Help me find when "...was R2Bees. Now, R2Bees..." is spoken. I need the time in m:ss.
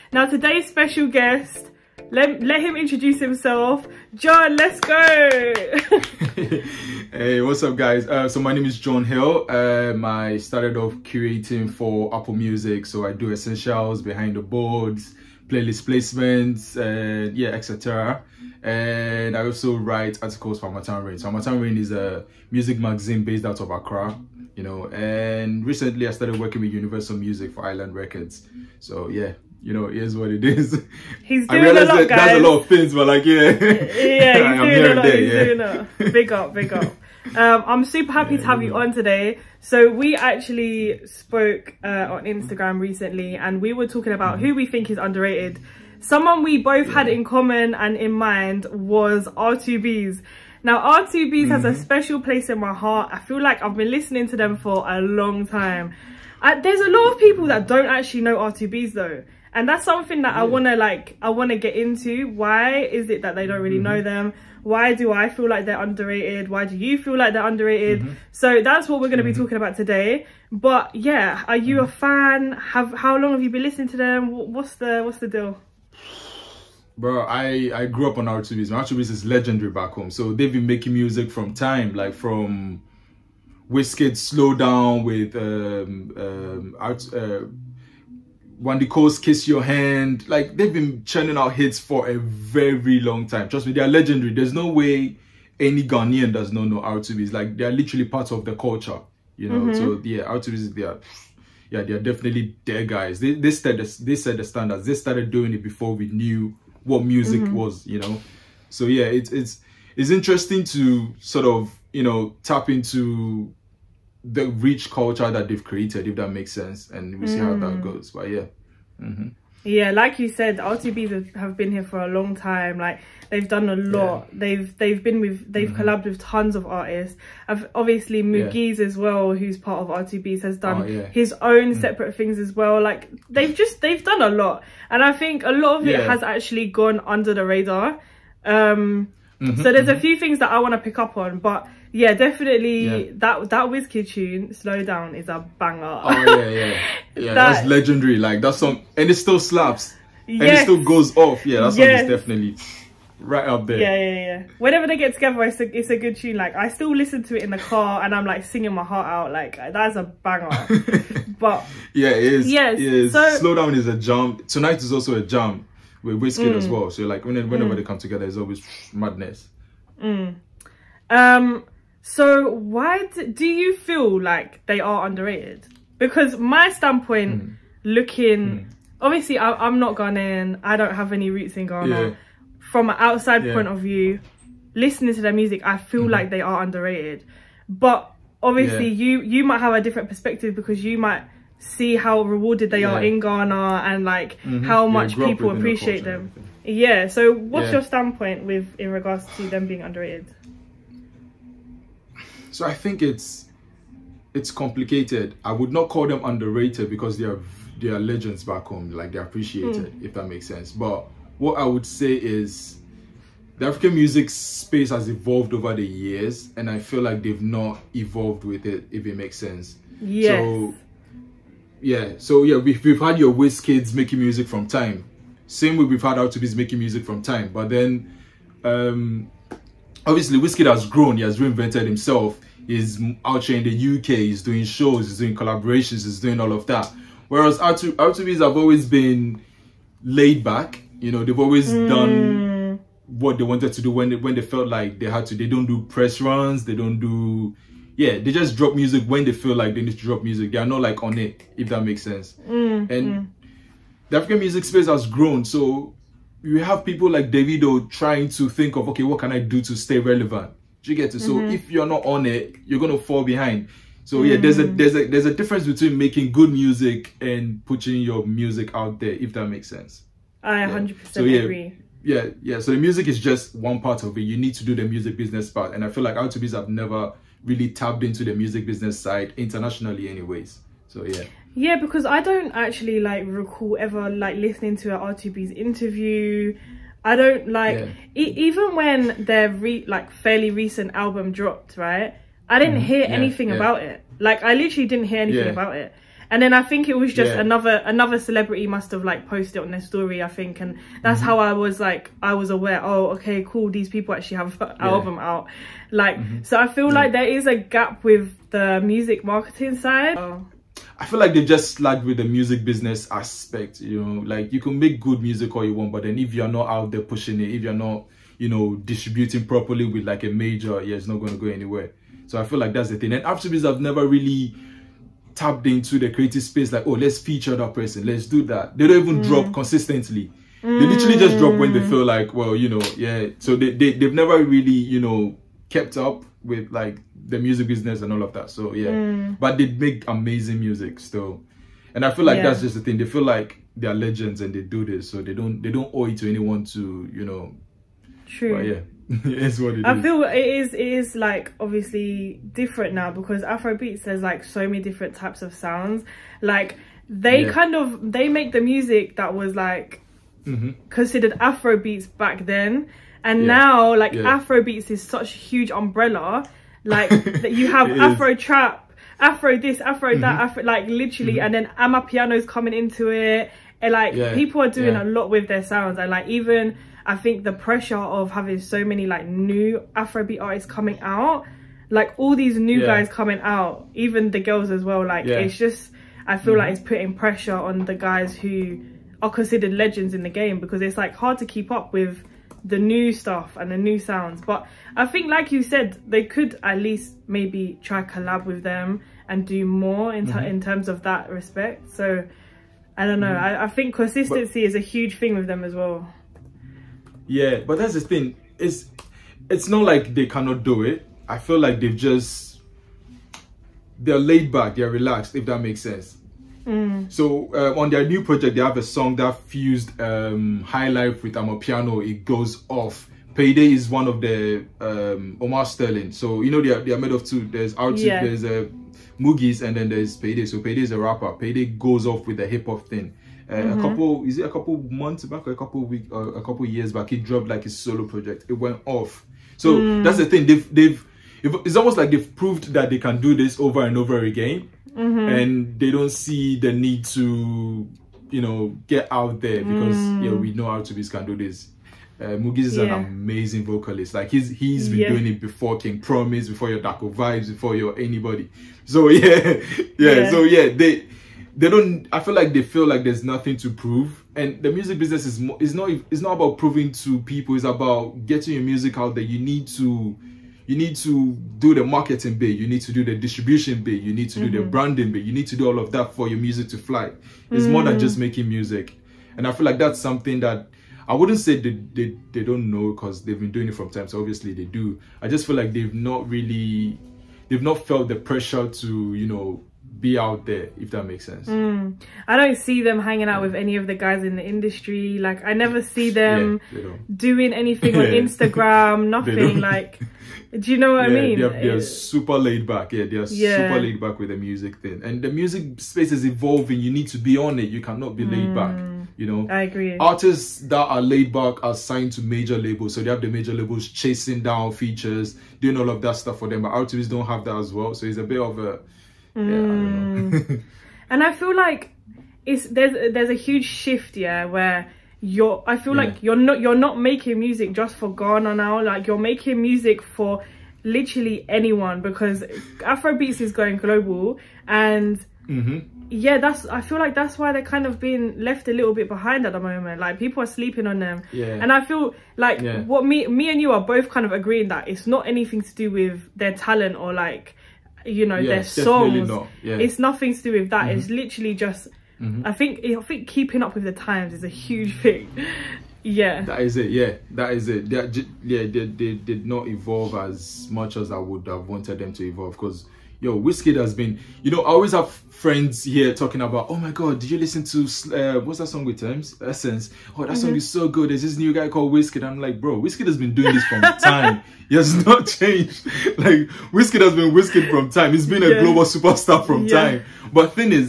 0:48.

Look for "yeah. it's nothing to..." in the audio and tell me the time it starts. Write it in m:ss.
9:09.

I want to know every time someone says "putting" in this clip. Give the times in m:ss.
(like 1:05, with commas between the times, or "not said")
4:27, 6:26.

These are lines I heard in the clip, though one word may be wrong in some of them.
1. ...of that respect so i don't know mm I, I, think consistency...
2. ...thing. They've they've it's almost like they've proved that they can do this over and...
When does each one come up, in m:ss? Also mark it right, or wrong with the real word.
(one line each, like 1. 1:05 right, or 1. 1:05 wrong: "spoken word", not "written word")
1. 6:40 right
2. 7:20 right.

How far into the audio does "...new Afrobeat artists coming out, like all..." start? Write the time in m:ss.
6:19.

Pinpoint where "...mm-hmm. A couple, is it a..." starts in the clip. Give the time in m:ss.
7:13.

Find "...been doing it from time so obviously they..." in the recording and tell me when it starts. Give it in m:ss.
8:03.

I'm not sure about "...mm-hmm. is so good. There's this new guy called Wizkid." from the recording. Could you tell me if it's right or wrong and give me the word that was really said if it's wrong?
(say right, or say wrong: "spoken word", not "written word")
right.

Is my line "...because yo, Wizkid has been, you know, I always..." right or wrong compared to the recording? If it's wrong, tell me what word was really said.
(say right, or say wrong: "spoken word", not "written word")
right.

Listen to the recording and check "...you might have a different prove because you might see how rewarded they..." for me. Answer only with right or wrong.
wrong.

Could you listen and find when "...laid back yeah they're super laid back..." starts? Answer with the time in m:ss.
8:22.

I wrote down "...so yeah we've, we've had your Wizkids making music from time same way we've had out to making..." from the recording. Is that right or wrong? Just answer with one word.
right.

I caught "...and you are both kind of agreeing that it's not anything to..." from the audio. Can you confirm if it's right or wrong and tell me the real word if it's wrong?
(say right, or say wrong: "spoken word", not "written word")
right.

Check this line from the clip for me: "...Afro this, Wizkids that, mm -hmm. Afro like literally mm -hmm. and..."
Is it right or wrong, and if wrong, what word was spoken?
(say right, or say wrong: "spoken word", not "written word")
wrong: "Afro", not "Wizkids".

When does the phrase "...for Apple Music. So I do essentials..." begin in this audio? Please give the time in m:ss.
0:11.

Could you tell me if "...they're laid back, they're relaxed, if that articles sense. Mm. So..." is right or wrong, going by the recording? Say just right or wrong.
wrong.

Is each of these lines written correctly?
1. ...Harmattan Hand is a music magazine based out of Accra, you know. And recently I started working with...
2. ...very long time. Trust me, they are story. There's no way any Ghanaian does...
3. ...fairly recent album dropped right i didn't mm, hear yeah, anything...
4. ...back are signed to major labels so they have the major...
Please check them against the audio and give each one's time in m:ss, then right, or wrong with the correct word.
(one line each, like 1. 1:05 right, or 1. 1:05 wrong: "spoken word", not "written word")
1. 0:21 wrong: "Rain", not "Hand"
2. 1:32 wrong: "legendary", not "story"
3. 4:50 right
4. 8:31 right.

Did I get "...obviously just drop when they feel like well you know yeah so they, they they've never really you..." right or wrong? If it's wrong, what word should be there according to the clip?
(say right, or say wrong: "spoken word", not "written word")
wrong: "literally", not "obviously".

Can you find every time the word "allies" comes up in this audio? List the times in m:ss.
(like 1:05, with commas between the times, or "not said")
not said.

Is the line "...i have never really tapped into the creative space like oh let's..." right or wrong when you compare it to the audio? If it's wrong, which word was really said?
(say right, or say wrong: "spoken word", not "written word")
right.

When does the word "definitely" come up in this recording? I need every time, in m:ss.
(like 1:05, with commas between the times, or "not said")
1:42, 2:22, 2:32.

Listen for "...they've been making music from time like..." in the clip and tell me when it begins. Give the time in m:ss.
1:20.